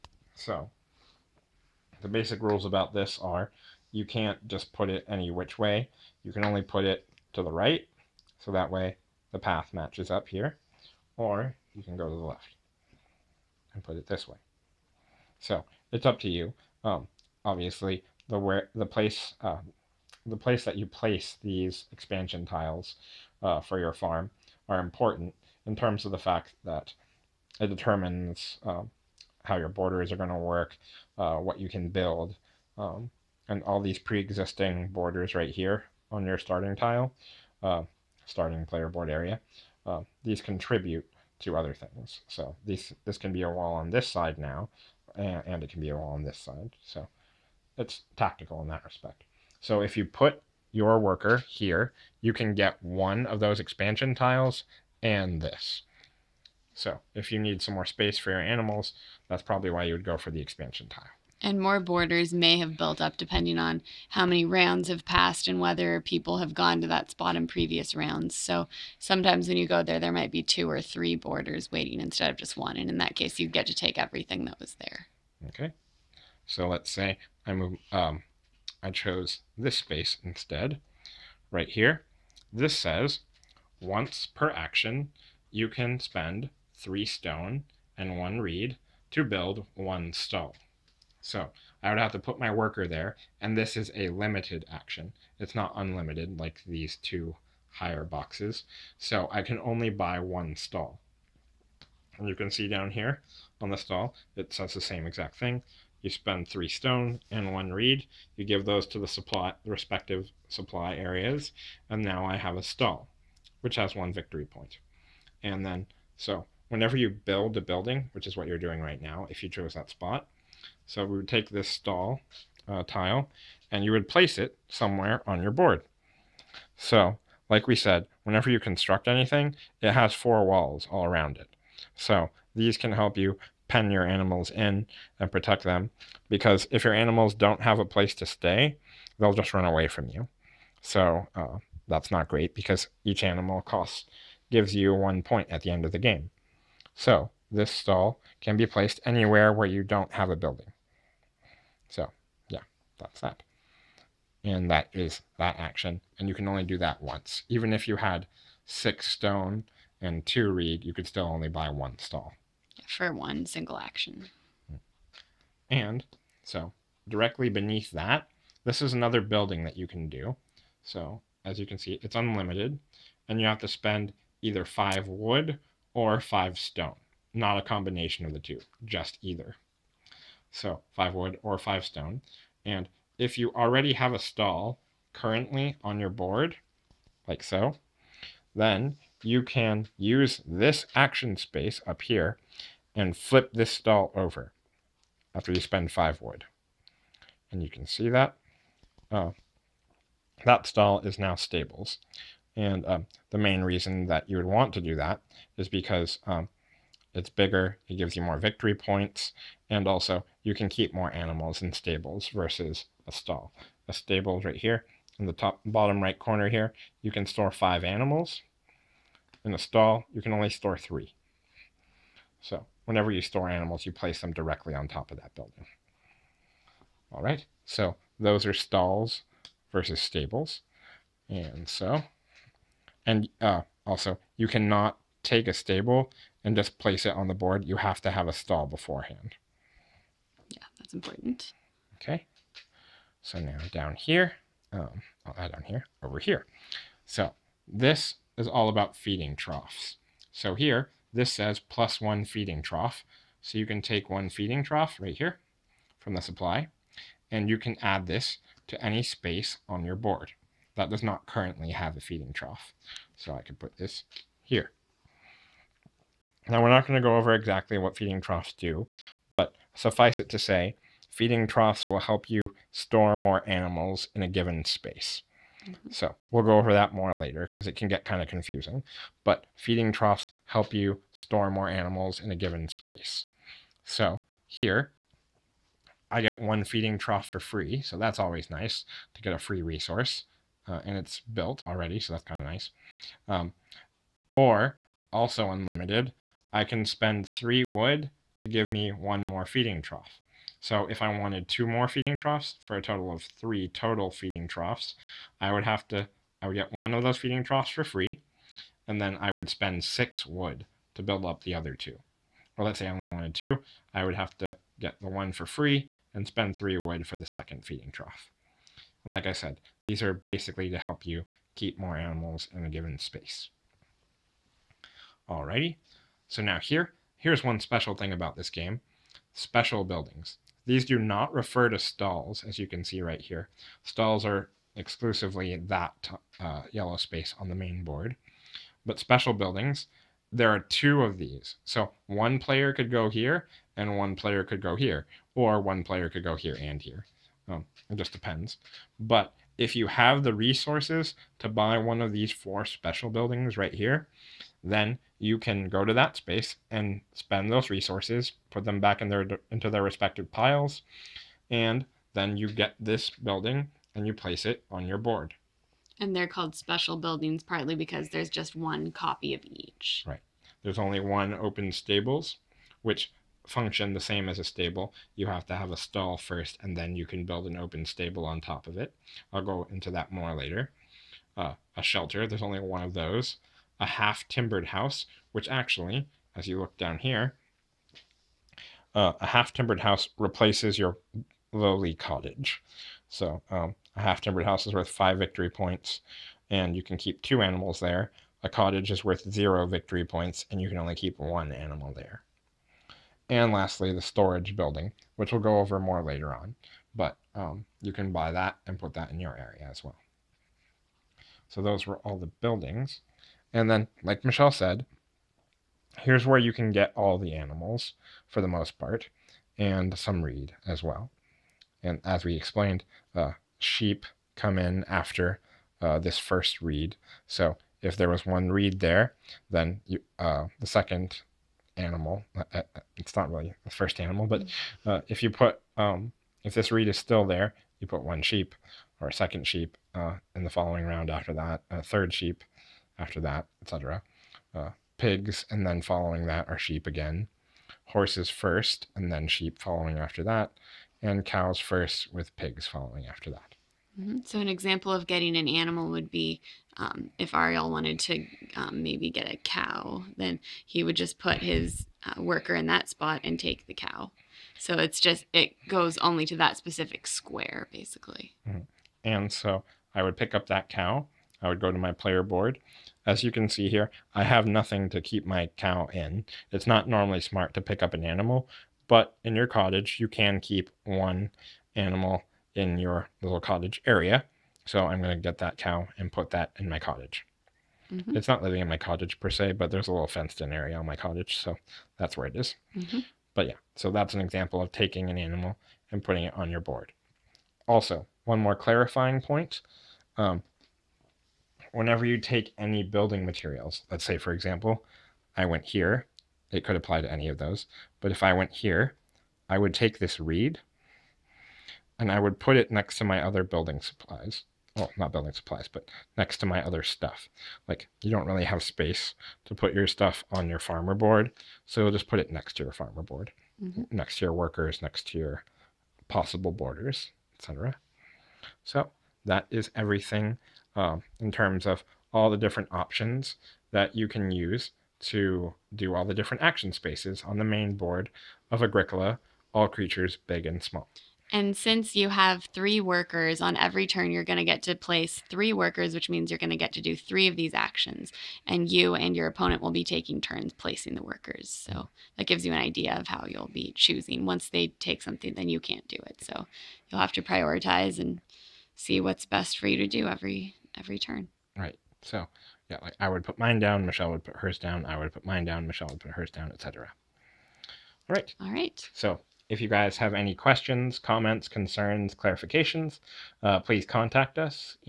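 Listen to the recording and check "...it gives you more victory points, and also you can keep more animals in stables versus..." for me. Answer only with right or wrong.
right.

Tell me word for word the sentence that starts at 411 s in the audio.
So those were all the buildings.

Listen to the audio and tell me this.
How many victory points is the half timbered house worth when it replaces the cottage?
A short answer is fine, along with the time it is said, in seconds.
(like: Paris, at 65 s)
5, at 394 s.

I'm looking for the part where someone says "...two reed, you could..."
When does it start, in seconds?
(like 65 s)
160 s.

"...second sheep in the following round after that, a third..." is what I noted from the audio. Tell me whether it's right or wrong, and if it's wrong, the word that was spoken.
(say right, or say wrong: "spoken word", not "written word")
right.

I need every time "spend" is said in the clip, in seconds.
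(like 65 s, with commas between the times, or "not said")
85 s, 106 s, 173 s, 195 s, 296 s, 309 s, 316 s, 357 s.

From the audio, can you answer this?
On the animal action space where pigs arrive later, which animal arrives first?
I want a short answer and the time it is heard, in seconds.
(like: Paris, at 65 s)
cows, at 451 s.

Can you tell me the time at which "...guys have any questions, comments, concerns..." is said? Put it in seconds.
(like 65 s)
569 s.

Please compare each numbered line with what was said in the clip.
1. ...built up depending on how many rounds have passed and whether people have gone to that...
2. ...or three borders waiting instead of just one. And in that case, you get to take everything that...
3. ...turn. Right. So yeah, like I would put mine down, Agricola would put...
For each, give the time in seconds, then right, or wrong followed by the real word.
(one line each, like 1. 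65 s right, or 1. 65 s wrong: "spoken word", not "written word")
1. 62 s right
2. 70 s right
3. 560 s wrong: "Michelle", not "Agricola".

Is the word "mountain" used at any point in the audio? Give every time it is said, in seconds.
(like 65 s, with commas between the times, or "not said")
not said.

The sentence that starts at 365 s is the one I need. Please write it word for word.
And they're called special buildings partly because there's just one copy of each.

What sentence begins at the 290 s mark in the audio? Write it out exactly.
Uh, and it's built already, so that's kind of nice.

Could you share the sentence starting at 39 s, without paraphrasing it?
Uh, these contribute to other things.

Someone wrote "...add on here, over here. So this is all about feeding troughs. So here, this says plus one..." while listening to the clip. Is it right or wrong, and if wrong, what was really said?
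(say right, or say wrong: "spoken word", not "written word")
right.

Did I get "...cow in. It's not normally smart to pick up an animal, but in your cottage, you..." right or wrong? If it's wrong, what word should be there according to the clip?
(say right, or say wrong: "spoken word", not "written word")
right.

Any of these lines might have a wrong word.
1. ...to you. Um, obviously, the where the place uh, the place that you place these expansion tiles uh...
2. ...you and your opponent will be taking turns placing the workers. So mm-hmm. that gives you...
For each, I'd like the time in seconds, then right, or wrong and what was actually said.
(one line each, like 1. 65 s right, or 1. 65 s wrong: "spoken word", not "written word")
1. 16 s right
2. 548 s right.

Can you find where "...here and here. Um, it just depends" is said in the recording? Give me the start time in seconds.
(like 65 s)
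346 s.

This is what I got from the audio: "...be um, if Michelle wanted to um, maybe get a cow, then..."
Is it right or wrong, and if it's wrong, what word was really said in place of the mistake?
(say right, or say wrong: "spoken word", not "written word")
wrong: "Ariel", not "Michelle".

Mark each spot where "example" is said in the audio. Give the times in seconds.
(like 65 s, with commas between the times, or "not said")
454 s, 494 s, 504 s.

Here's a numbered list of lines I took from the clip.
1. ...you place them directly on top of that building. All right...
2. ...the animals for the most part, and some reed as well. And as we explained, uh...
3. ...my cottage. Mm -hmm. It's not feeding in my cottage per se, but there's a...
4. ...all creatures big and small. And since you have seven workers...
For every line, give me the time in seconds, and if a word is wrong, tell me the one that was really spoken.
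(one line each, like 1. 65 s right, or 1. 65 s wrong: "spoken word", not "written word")
1. 223 s right
2. 417 s right
3. 486 s wrong: "living", not "feeding"
4. 539 s wrong: "three", not "seven".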